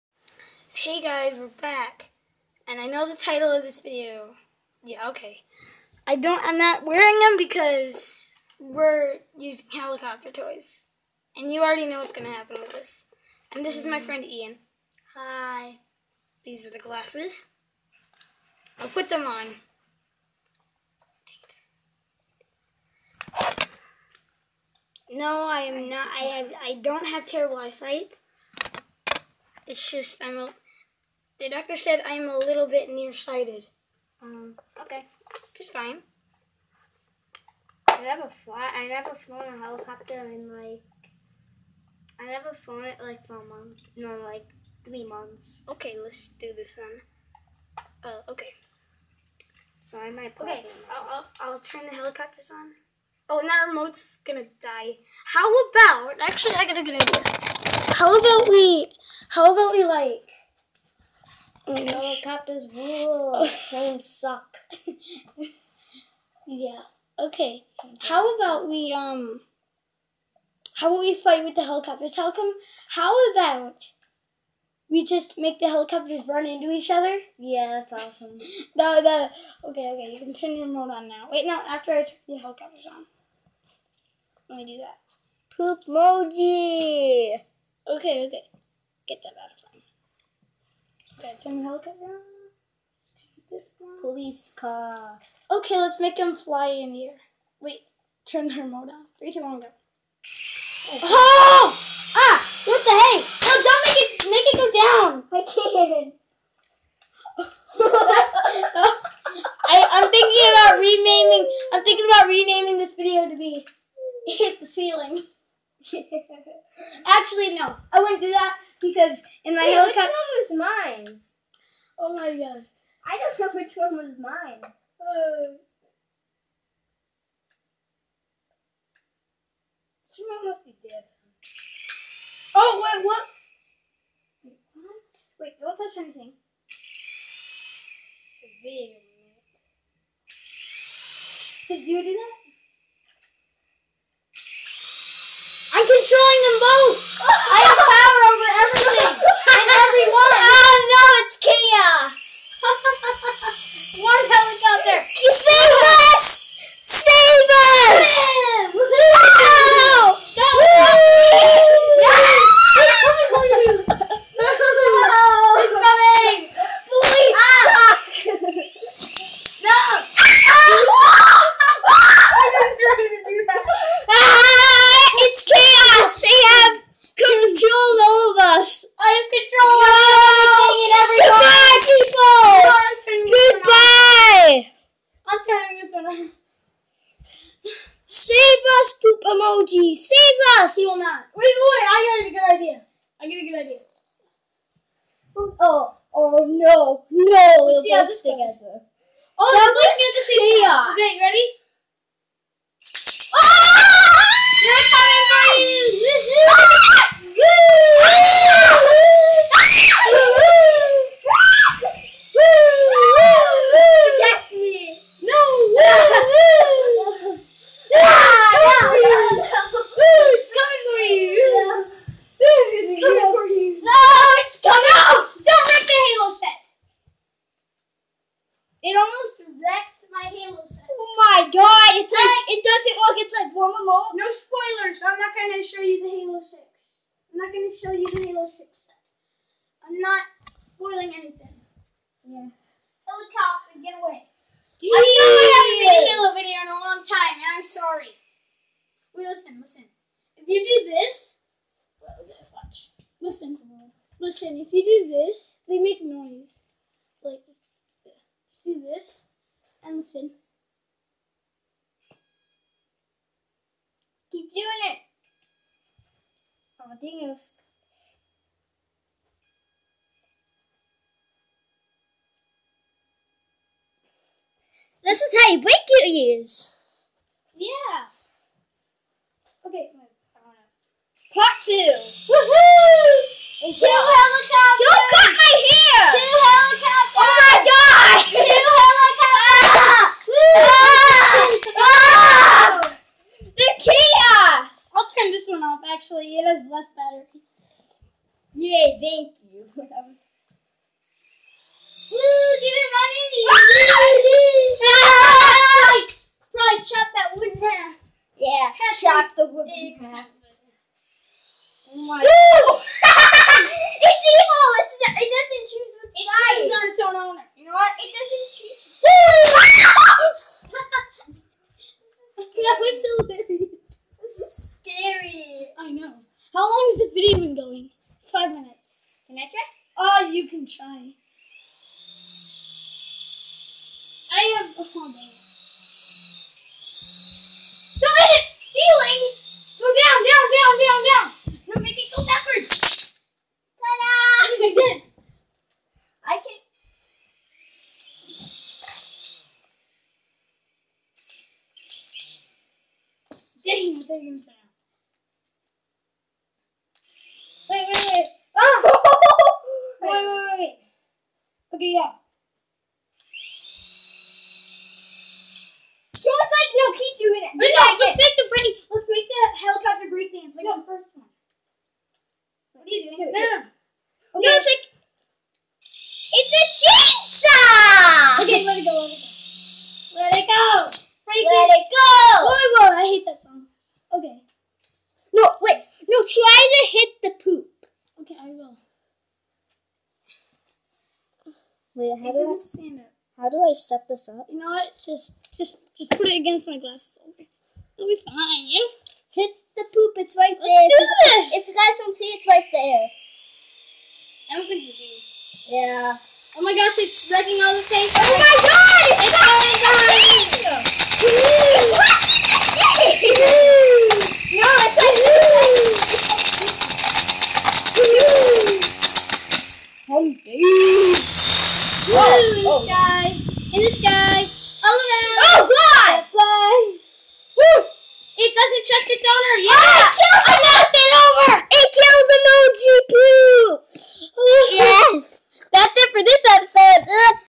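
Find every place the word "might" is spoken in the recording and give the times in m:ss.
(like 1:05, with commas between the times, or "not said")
0:50.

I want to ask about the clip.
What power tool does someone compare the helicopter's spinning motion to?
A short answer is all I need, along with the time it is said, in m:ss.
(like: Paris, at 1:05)
Chainsaw, at 6:16.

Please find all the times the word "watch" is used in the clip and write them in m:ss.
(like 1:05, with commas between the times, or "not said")
4:12.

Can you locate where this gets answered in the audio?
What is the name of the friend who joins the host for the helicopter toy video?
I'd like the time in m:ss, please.
0:14.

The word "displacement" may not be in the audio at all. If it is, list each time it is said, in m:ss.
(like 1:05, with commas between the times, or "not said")
not said.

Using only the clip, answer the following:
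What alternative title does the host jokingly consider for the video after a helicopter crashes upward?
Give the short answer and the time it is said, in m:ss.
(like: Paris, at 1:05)
Hit the Ceiling, at 1:54.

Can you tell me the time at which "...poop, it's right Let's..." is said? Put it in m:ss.
6:39.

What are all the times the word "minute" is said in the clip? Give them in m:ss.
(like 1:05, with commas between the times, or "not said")
2:18, 5:28.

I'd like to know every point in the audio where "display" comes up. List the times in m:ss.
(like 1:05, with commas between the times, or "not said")
not said.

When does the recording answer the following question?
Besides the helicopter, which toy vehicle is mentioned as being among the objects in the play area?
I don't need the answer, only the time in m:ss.
1:34.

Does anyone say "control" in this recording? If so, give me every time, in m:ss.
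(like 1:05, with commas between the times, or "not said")
2:59.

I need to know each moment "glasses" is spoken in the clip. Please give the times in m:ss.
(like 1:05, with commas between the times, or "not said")
0:16, 6:36.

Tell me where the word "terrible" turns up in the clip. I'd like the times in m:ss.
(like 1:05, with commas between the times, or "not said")
0:27.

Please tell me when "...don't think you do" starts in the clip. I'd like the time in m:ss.
6:44.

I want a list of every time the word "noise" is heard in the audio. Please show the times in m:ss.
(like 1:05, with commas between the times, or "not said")
4:16.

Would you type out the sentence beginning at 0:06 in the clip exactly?
I don't, I'm not wearing them because we're using helicopter toys.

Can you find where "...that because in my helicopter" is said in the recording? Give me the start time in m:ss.
1:58.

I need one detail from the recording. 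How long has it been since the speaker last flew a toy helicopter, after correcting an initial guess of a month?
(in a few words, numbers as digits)
3 months.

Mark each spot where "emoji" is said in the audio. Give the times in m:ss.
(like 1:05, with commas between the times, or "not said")
1:25, 3:09.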